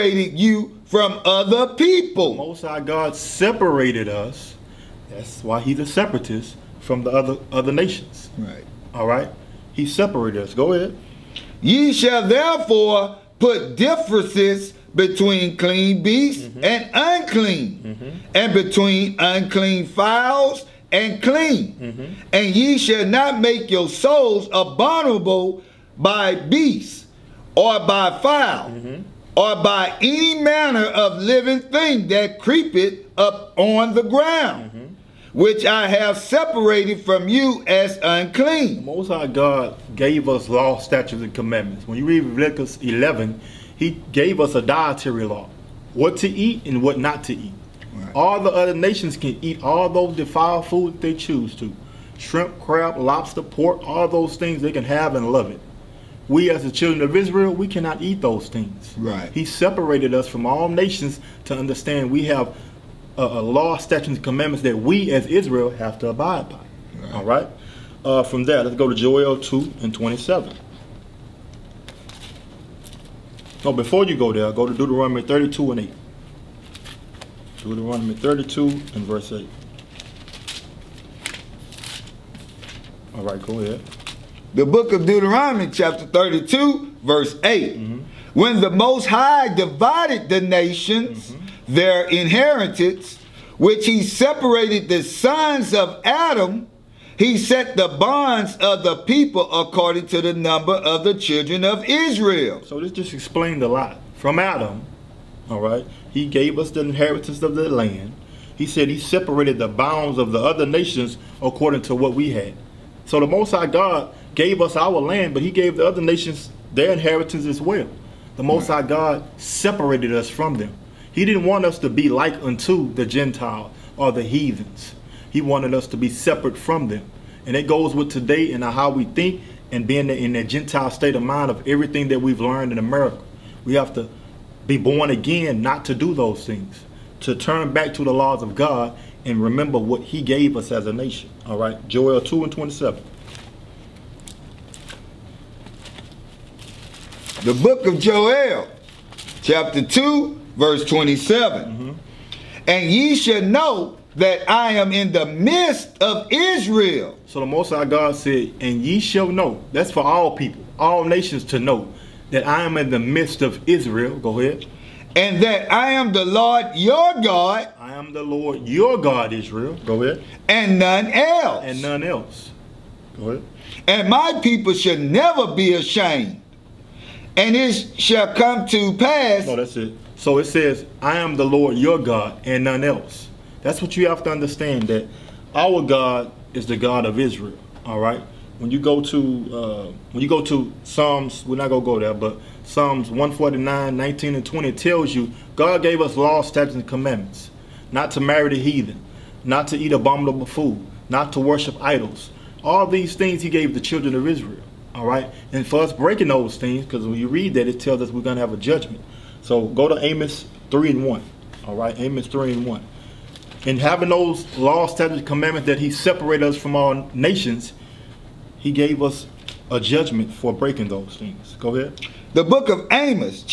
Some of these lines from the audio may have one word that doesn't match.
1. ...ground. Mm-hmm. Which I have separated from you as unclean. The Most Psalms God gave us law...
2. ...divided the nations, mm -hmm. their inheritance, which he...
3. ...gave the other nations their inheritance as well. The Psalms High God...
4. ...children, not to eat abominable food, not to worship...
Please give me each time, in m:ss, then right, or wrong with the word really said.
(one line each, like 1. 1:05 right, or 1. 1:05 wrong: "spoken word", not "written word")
1. 0:34 wrong: "High", not "Psalms"
2. 1:29 right
3. 1:55 wrong: "Most", not "Psalms"
4. 3:18 wrong: "heathen", not "children".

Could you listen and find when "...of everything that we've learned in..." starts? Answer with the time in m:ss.
2:11.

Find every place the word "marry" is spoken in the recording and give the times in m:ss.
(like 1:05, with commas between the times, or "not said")
3:18.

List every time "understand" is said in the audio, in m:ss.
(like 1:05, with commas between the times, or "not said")
1:01, 3:04.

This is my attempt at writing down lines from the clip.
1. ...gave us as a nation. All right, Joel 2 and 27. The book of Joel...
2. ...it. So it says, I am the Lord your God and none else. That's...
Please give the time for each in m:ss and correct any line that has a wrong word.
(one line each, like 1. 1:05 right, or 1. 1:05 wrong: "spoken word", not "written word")
1. 2:20 right
2. 2:59 right.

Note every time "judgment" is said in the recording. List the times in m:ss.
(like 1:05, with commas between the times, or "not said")
3:28, 3:39.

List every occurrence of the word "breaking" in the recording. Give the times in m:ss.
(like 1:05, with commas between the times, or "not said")
3:25, 3:40.